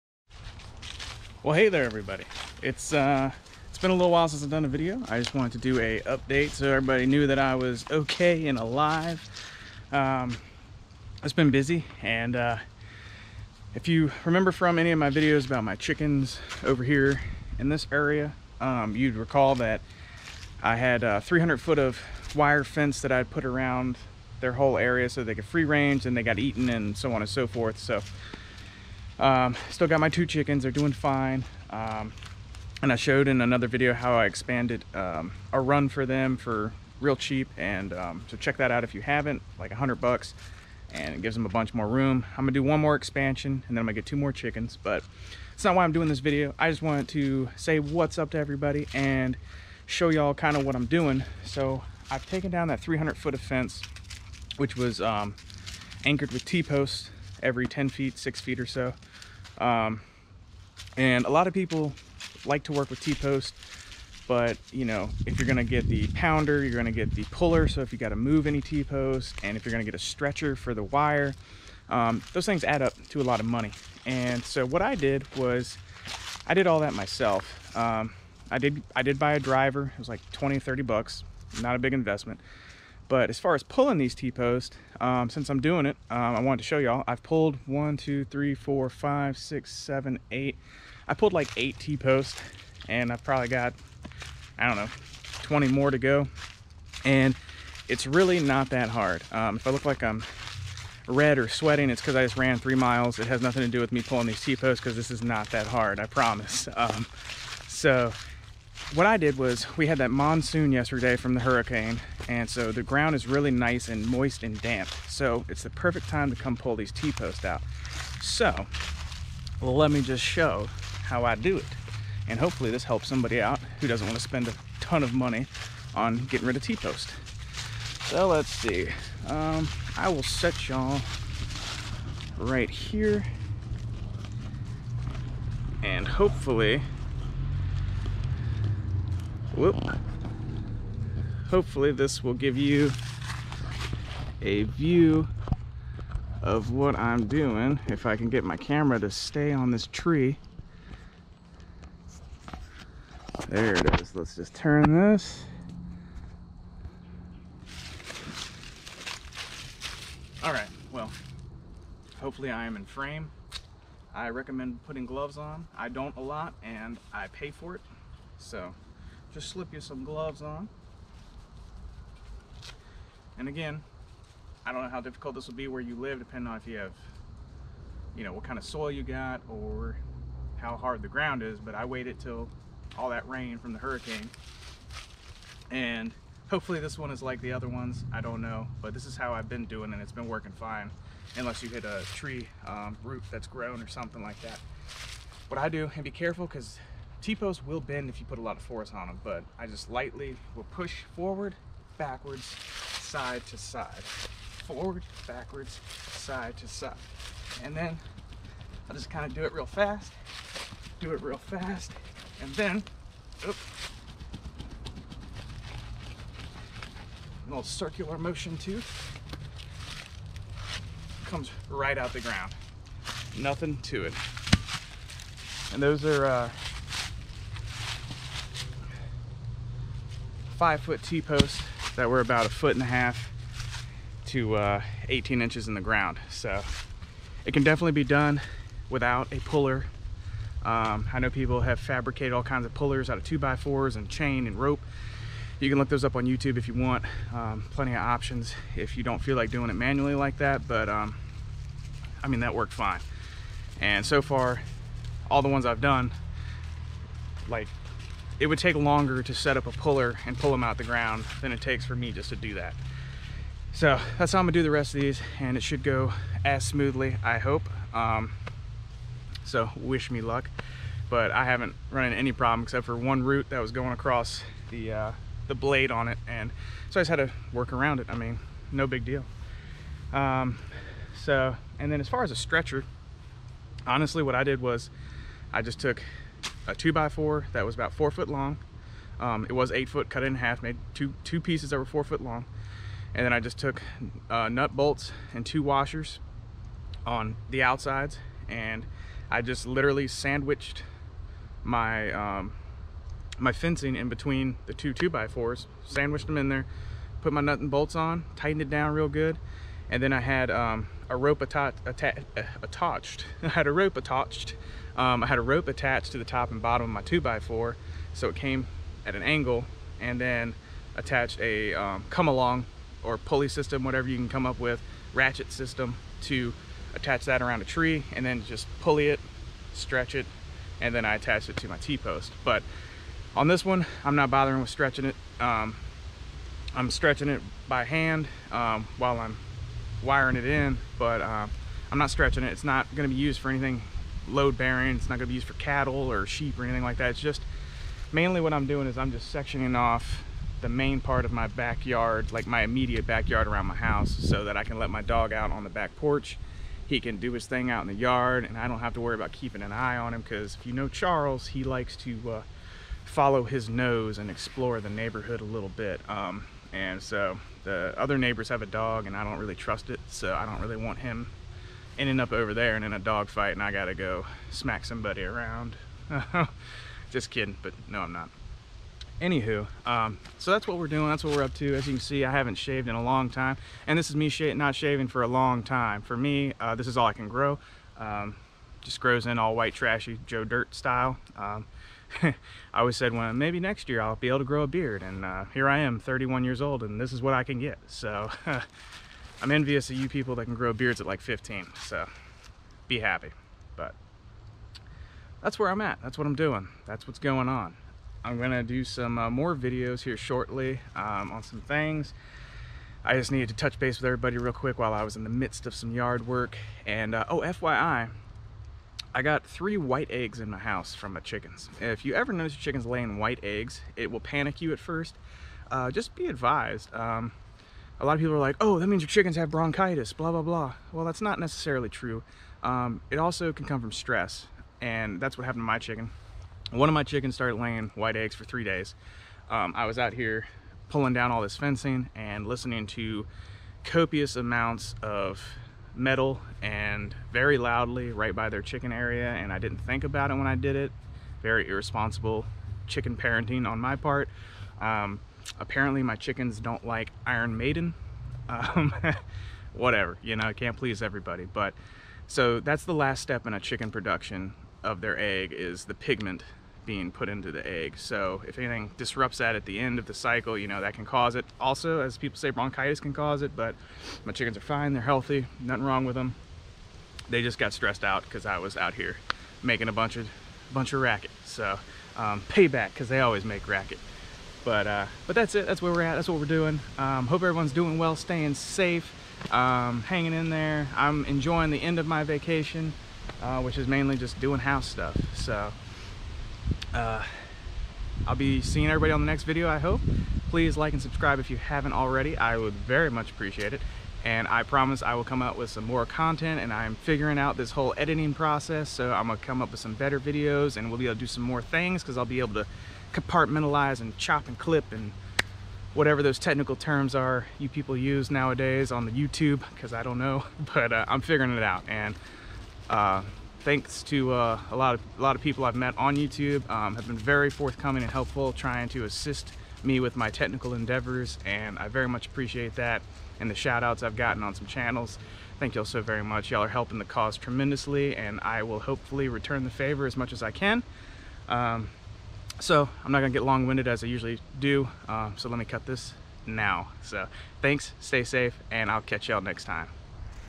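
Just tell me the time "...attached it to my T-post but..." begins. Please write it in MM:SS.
05:31.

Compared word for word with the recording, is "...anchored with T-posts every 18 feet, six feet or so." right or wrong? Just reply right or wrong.
wrong.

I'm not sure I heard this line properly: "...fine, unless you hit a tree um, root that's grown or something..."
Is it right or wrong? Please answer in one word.
right.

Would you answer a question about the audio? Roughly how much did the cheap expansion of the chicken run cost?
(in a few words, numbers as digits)
100 bucks.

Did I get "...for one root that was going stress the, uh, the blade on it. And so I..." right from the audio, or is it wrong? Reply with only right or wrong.
wrong.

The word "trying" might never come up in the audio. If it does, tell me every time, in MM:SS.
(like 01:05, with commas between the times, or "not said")
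08:48.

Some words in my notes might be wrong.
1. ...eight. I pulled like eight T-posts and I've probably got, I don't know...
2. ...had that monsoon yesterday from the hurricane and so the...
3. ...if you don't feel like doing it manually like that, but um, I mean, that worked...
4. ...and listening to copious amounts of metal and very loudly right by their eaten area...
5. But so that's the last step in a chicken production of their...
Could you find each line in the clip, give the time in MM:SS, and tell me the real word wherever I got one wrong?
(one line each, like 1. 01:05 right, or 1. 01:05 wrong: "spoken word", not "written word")
1. 01:30 right
2. 01:49 right
3. 04:08 right
4. 07:22 wrong: "chicken", not "eaten"
5. 07:41 right.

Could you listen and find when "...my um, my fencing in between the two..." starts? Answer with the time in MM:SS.
05:01.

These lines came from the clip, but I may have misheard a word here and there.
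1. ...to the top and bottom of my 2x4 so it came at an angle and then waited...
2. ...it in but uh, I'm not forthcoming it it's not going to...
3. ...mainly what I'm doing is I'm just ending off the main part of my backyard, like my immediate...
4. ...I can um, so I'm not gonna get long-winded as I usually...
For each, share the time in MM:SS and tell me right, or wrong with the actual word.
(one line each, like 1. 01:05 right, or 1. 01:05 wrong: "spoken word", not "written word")
1. 05:16 wrong: "attached", not "waited"
2. 05:40 wrong: "stretching", not "forthcoming"
3. 05:48 wrong: "sectioning", not "ending"
4. 09:00 right.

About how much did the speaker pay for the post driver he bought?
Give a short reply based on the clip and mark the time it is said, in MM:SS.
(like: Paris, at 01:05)
20 to 30 bucks, at 01:20.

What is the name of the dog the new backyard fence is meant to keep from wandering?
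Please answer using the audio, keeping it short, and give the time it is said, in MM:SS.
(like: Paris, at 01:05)
Charles, at 06:00.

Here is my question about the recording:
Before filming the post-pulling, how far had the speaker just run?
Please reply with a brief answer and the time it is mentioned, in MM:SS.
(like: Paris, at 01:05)
3 miles, at 01:42.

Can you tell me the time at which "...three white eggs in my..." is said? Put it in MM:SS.
06:59.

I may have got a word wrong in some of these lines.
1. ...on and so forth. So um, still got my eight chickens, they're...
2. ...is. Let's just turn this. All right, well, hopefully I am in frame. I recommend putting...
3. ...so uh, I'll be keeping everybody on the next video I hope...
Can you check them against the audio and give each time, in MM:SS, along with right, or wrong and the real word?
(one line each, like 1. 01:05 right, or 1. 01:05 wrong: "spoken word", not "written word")
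1. 00:27 wrong: "two", not "eight"
2. 02:34 right
3. 08:15 wrong: "seeing", not "keeping".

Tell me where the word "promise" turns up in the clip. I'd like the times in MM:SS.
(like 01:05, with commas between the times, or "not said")
01:46, 08:24.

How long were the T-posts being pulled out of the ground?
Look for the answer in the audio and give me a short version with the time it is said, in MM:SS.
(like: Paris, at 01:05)
5 foot, at 03:50.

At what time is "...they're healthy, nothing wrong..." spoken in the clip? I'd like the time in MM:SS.
07:54.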